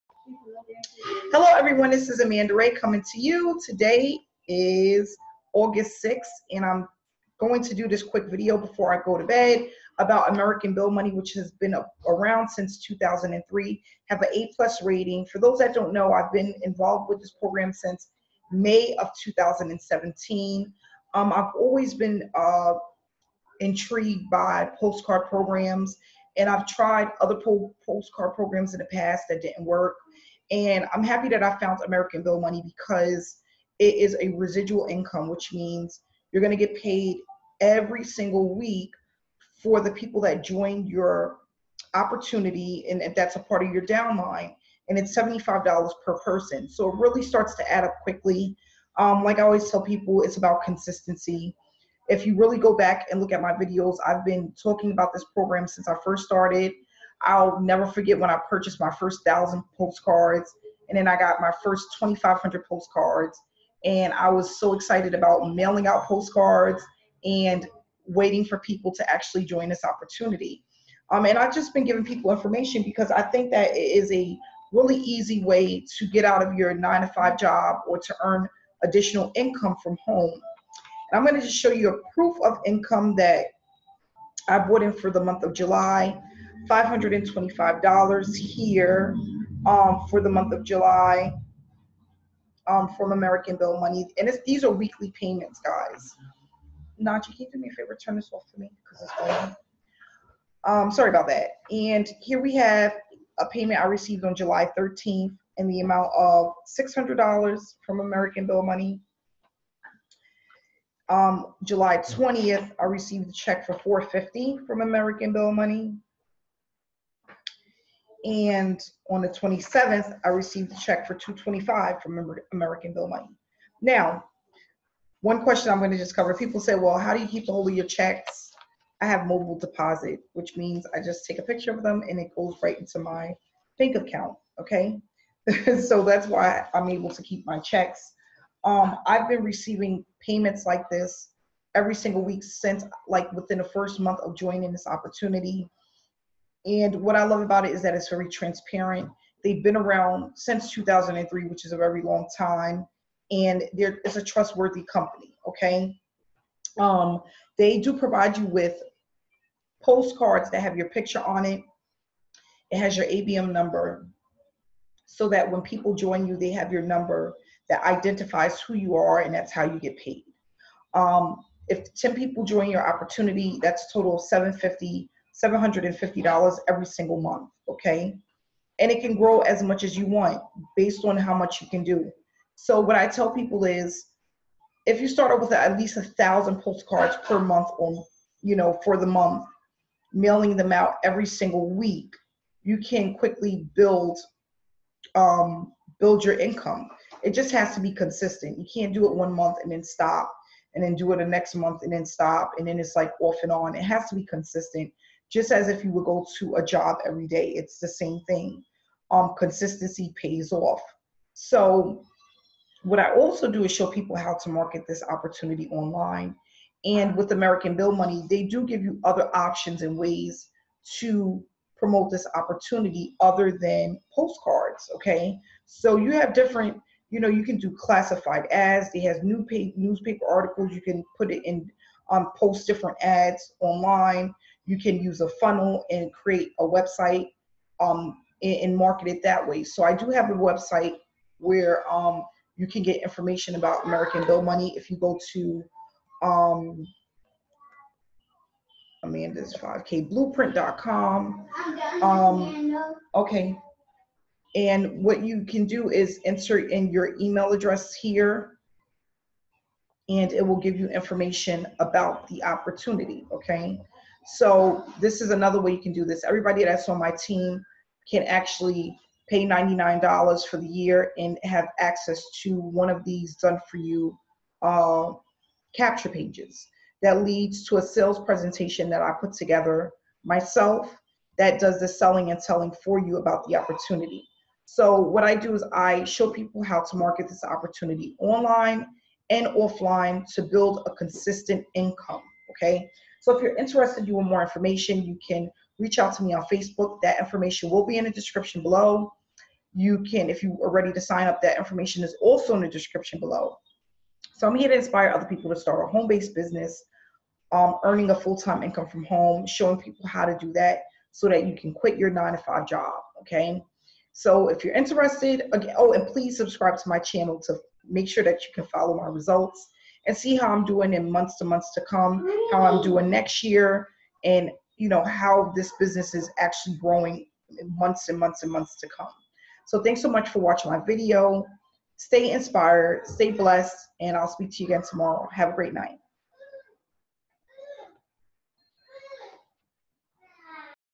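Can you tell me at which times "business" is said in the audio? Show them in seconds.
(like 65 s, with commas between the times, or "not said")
306 s, 325 s.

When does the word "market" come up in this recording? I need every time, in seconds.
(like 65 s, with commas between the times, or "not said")
214 s, 238 s, 286 s.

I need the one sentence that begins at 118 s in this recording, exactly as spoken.
And on the 27th, I received a check for 225 from American Bill Money.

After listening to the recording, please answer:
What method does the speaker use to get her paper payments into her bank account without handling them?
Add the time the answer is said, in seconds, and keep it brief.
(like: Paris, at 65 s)
Mobile deposit, at 129 s.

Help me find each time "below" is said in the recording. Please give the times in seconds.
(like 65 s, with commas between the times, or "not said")
298 s, 303 s.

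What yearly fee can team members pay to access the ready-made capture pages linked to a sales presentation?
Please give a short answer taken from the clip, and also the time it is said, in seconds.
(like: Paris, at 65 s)
$99, at 269 s.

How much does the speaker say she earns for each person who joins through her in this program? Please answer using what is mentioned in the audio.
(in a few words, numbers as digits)
$75.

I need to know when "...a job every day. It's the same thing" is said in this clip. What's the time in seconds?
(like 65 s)
206 s.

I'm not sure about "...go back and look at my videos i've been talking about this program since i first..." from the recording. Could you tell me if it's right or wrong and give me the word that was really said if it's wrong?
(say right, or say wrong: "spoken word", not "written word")
right.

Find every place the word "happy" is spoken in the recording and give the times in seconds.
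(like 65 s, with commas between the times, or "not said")
31 s.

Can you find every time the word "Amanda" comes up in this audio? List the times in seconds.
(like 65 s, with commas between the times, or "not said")
2 s, 249 s.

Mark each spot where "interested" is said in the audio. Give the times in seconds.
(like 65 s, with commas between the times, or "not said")
293 s, 314 s.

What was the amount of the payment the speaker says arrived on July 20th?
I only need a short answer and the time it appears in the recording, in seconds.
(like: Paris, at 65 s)
$450, at 113 s.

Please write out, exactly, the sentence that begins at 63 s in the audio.
And I was so excited about mailing out postcards and waiting for people to actually join this opportunity.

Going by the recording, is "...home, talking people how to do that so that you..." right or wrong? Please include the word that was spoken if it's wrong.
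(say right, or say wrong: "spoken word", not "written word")
wrong: "showing", not "talking".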